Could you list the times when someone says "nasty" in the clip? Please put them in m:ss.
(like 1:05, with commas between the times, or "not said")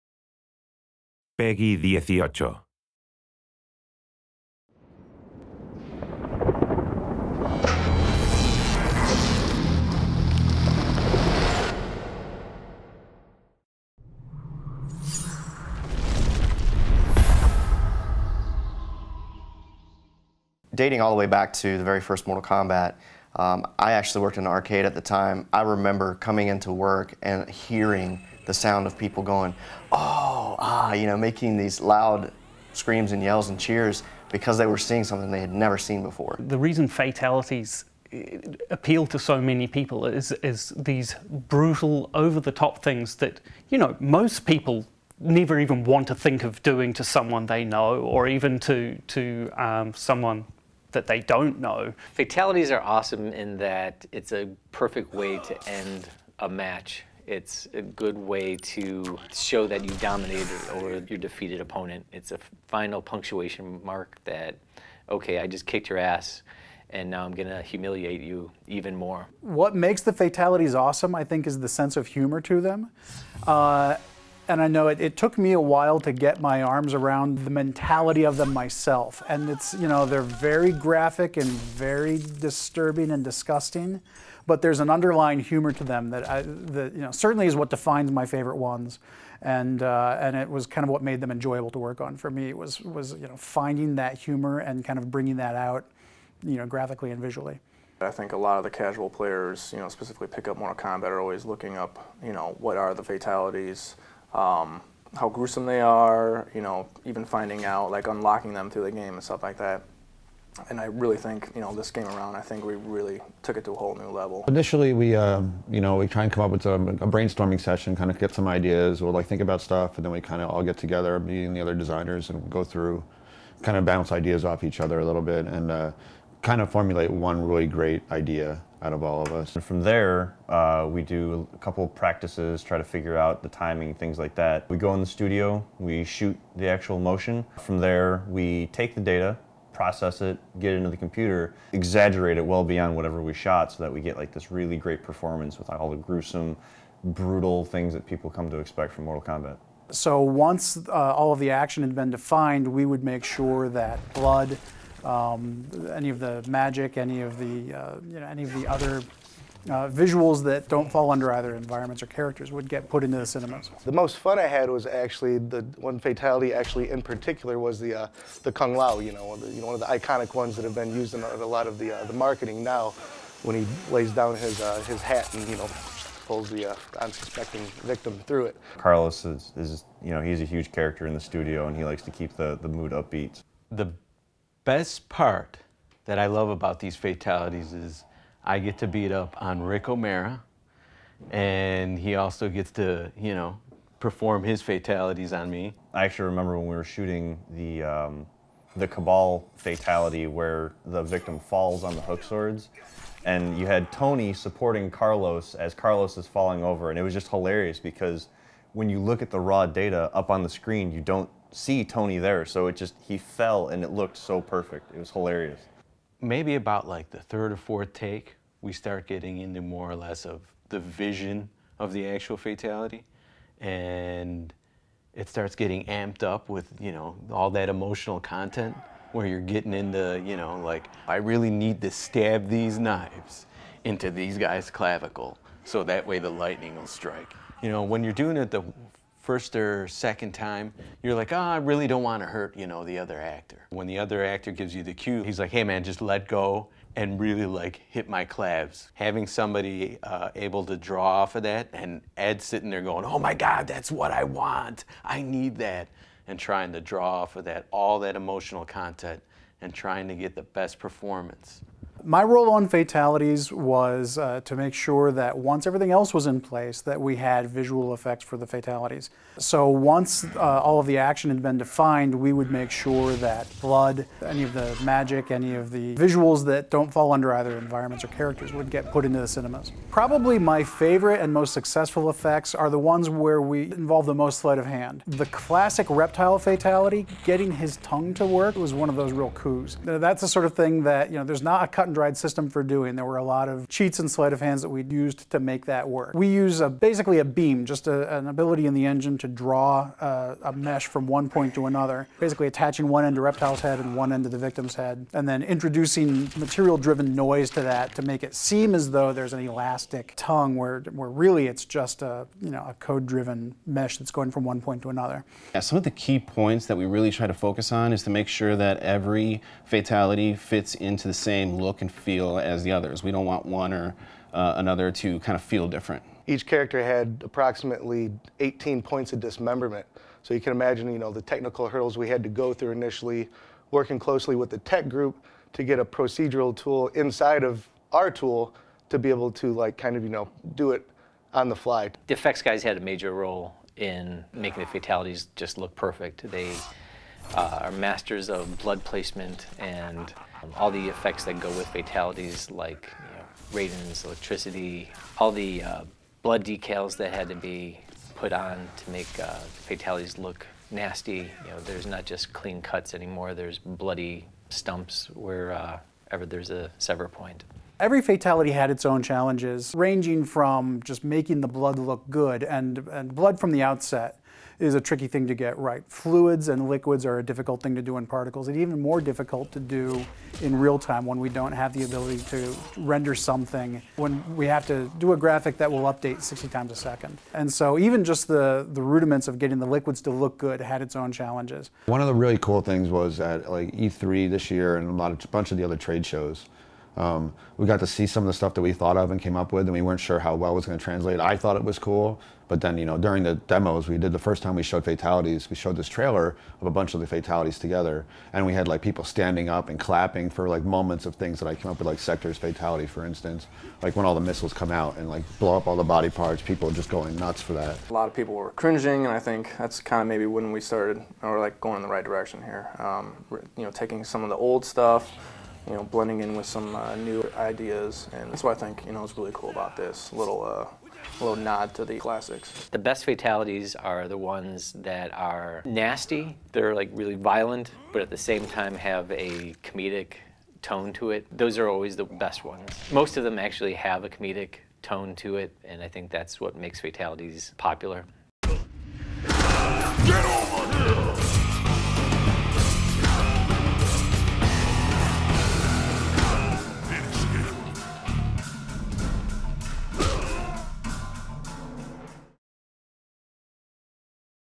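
6:00, 7:15.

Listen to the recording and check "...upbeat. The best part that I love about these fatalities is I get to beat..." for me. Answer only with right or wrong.
right.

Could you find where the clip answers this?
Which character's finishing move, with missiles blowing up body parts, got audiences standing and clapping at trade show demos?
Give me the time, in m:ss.
6:51.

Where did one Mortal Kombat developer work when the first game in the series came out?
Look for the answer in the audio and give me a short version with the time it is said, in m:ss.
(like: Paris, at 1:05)
an arcade, at 0:24.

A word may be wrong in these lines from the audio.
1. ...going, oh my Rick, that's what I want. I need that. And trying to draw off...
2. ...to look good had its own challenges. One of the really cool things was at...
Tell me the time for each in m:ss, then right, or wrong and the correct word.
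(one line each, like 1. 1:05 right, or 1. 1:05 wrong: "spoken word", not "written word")
1. 4:12 wrong: "God", not "Rick"
2. 6:30 right.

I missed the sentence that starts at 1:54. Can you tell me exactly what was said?
Initially, we uh, you know we try and come up with a, a, brainstorming session, kind of get some ideas.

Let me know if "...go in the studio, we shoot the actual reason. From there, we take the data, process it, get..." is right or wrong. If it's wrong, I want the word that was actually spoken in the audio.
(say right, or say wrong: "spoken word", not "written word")
wrong: "motion", not "reason".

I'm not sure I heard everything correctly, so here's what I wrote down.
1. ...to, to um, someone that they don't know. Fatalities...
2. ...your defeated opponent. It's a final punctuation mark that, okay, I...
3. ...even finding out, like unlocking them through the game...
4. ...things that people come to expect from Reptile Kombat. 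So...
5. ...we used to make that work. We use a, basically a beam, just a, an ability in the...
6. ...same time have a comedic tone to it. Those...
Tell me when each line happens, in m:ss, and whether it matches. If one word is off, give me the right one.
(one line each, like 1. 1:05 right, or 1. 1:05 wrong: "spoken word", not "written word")
1. 0:48 right
2. 1:01 right
3. 1:47 right
4. 2:27 wrong: "Mortal", not "Reptile"
5. 4:54 right
6. 7:18 right.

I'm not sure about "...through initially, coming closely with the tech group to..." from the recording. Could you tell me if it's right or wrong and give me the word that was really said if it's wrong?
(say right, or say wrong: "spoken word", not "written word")
wrong: "working", not "coming".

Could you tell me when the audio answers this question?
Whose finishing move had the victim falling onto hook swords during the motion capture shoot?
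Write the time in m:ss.
3:18.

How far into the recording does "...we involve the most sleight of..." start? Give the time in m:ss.
4:43.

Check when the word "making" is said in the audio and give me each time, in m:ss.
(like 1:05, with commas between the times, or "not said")
0:31, 5:44, 6:11.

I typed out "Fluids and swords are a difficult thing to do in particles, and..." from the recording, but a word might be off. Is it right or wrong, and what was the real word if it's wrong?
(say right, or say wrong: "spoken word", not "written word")
wrong: "liquids", not "swords".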